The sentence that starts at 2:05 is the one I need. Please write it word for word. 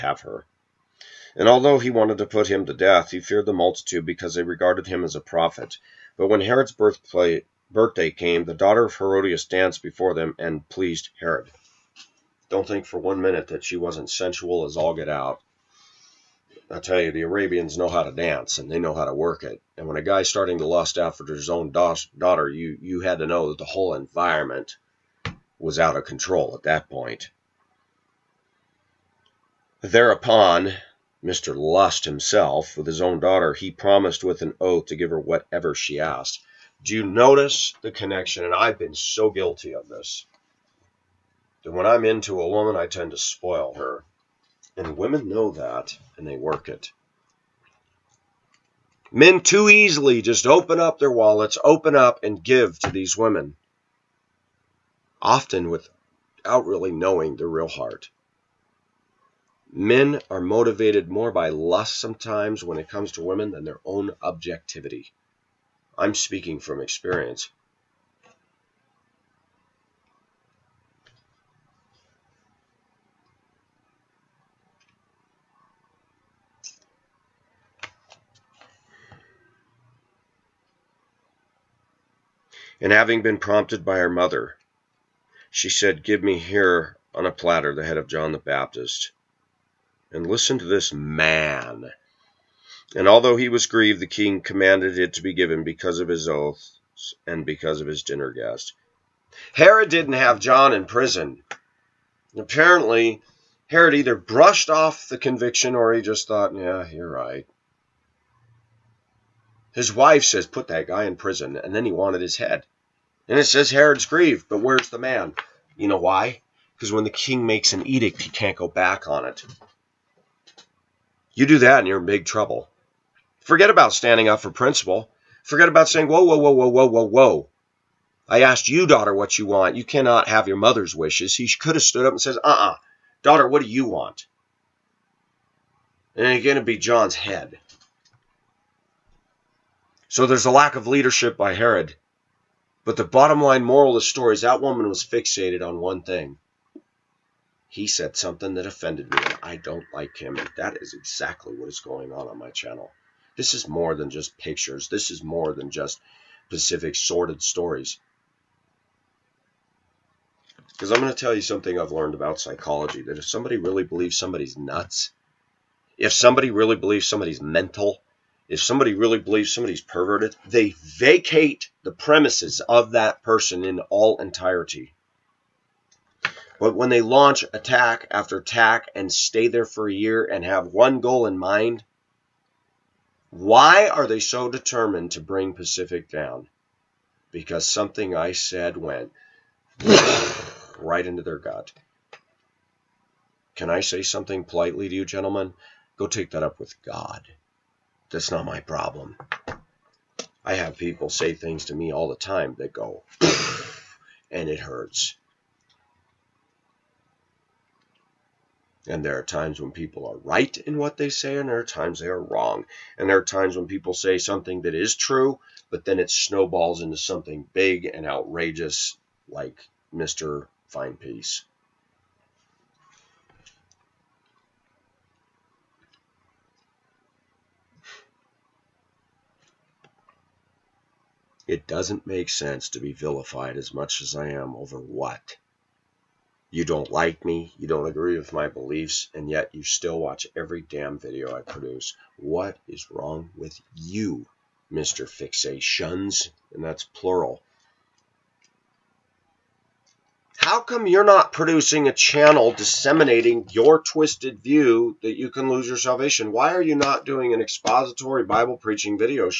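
Forget about saying, whoa, whoa, whoa, whoa, whoa, whoa, whoa.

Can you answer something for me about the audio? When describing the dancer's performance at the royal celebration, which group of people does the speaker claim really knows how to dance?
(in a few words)
Arabians.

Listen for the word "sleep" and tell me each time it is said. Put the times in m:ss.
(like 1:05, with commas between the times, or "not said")
not said.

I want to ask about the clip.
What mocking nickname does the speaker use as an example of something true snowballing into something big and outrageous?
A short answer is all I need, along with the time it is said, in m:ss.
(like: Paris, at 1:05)
Mr. Fine Piece, at 3:39.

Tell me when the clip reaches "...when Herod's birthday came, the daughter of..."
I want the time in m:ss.
0:06.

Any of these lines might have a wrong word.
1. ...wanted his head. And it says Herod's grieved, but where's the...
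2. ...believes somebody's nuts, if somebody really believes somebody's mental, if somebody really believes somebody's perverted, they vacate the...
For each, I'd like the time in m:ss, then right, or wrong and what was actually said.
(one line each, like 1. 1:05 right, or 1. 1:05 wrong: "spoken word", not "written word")
1. 1:51 right
2. 2:43 right.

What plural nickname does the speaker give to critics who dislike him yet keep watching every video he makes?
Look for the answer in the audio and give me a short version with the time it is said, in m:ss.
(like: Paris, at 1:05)
Mr. Fixations, at 4:04.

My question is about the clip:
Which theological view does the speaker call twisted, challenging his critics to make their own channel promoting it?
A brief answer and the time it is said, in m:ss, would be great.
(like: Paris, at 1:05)
You can lose your salvation, at 4:15.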